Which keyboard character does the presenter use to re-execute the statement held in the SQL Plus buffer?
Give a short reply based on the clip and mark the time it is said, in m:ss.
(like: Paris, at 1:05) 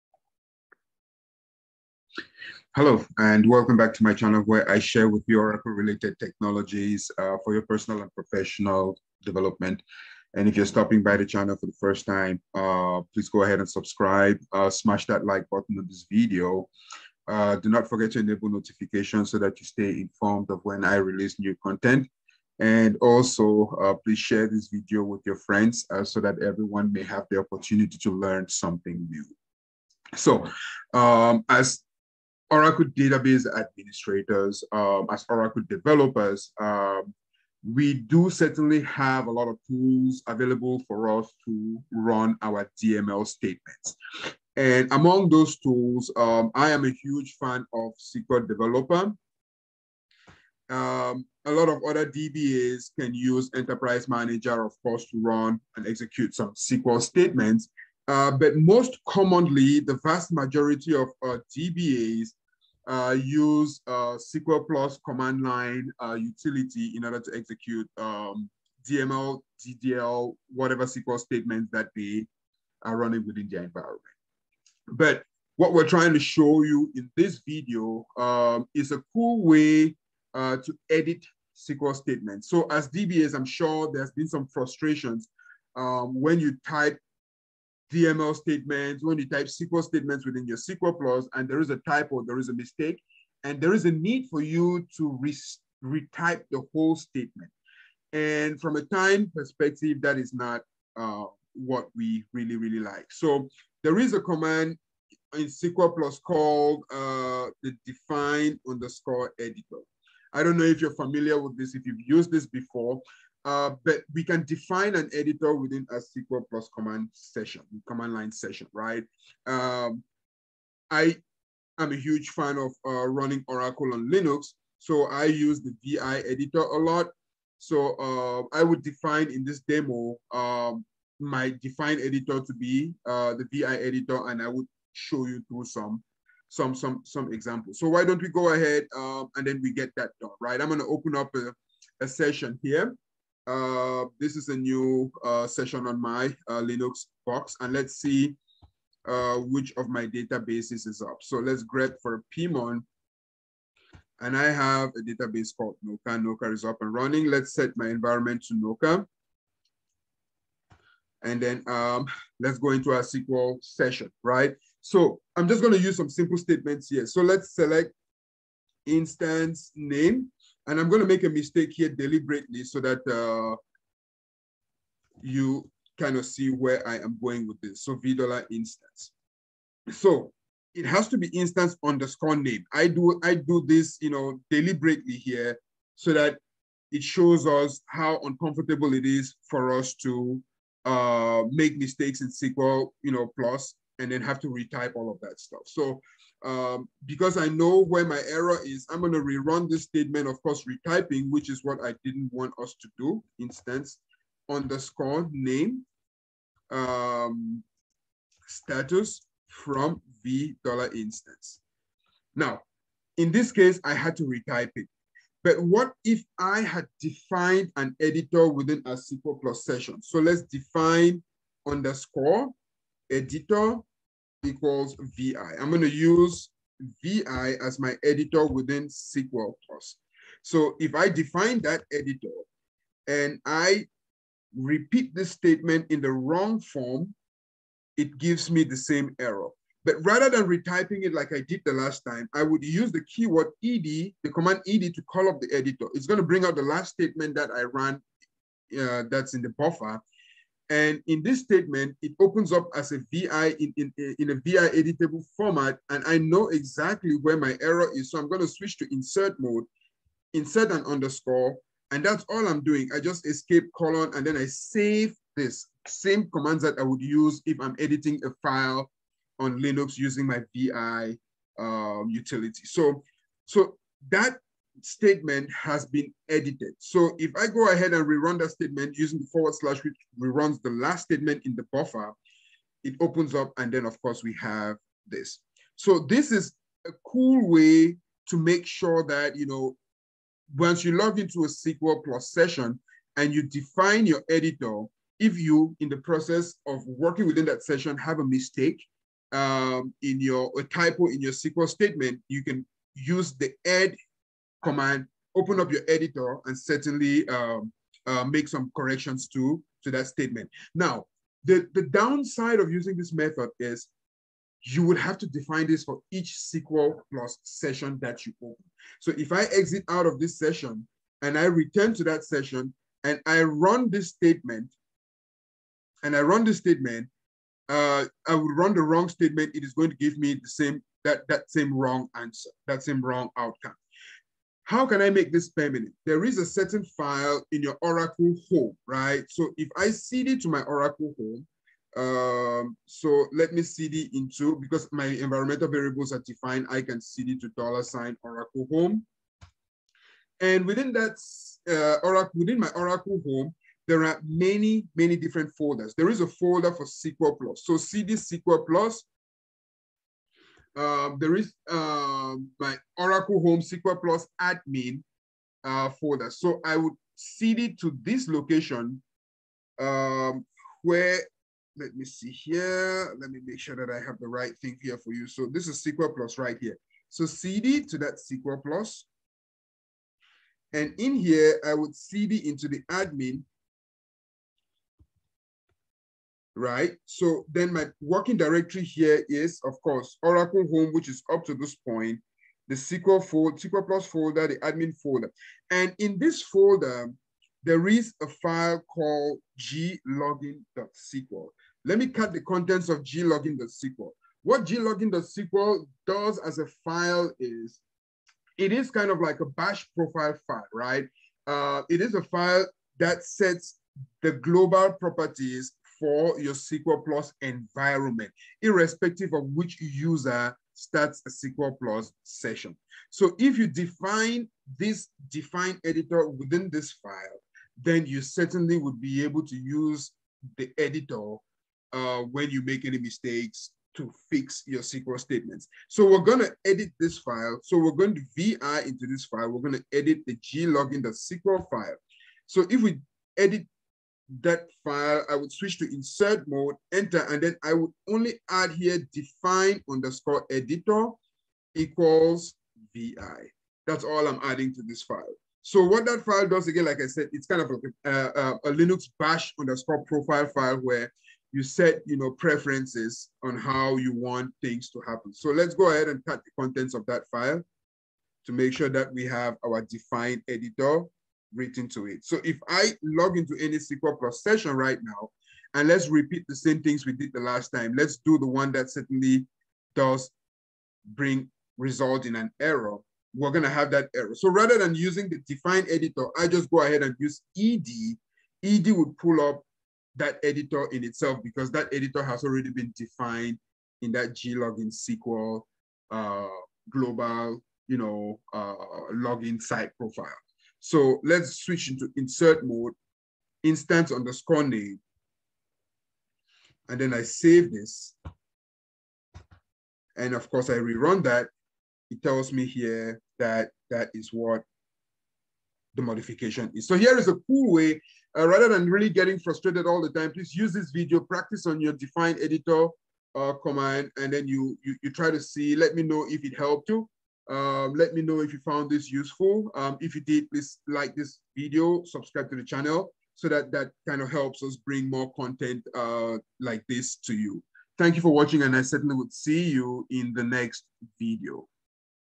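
forward slash, at 4:39.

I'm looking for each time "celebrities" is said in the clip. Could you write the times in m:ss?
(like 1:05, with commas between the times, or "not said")
not said.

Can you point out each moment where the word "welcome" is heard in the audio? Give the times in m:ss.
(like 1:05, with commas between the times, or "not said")
0:03.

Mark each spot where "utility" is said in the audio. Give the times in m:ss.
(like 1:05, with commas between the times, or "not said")
1:06, 4:32.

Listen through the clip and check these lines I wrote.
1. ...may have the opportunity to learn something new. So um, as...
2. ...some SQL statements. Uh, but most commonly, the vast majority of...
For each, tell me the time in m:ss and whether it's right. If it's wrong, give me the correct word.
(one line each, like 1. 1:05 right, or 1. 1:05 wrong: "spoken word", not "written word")
1. 0:26 right
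2. 0:56 right.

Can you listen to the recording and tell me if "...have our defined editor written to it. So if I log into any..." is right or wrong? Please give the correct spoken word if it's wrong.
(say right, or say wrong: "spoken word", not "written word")
right.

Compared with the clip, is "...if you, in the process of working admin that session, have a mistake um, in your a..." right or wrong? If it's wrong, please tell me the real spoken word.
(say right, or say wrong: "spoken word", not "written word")
wrong: "within", not "admin".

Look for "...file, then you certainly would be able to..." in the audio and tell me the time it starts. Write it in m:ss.
7:06.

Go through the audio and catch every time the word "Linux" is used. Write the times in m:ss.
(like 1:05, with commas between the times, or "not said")
2:04, 2:26, 4:29, 7:38.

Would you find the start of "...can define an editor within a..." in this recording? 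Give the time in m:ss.
1:54.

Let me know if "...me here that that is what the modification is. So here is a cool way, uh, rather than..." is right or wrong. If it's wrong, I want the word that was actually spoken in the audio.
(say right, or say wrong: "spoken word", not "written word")
right.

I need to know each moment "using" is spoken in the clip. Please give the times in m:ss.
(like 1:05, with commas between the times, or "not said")
4:29, 4:38, 5:12, 8:04.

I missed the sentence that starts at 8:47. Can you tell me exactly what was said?
Um, let me know if you found this useful.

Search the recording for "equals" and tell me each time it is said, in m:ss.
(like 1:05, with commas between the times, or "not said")
3:44, 7:31.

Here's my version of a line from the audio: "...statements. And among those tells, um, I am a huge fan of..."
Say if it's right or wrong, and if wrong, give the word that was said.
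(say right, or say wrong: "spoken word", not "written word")
wrong: "tools", not "tells".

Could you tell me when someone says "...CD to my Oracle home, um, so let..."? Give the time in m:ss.
5:39.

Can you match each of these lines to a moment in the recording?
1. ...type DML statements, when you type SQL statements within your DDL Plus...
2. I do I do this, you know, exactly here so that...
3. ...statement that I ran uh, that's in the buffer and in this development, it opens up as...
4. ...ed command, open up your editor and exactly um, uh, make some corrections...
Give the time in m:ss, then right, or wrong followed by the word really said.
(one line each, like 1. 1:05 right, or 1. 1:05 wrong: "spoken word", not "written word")
1. 1:26 wrong: "SQL", not "DDL"
2. 3:02 wrong: "deliberately", not "exactly"
3. 4:06 wrong: "statement", not "development"
4. 5:03 wrong: "certainly", not "exactly".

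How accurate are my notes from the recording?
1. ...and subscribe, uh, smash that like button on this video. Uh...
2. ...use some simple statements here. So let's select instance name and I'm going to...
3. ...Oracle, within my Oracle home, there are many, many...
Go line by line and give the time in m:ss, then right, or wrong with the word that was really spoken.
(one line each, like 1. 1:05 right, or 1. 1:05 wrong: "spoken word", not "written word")
1. 0:13 right
2. 2:45 right
3. 5:52 right.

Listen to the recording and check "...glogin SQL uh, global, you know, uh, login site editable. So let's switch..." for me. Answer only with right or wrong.
wrong.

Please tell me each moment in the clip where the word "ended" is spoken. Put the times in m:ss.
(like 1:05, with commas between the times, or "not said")
not said.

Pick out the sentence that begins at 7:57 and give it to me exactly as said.
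Let's do the one that certainly does bring result in an error.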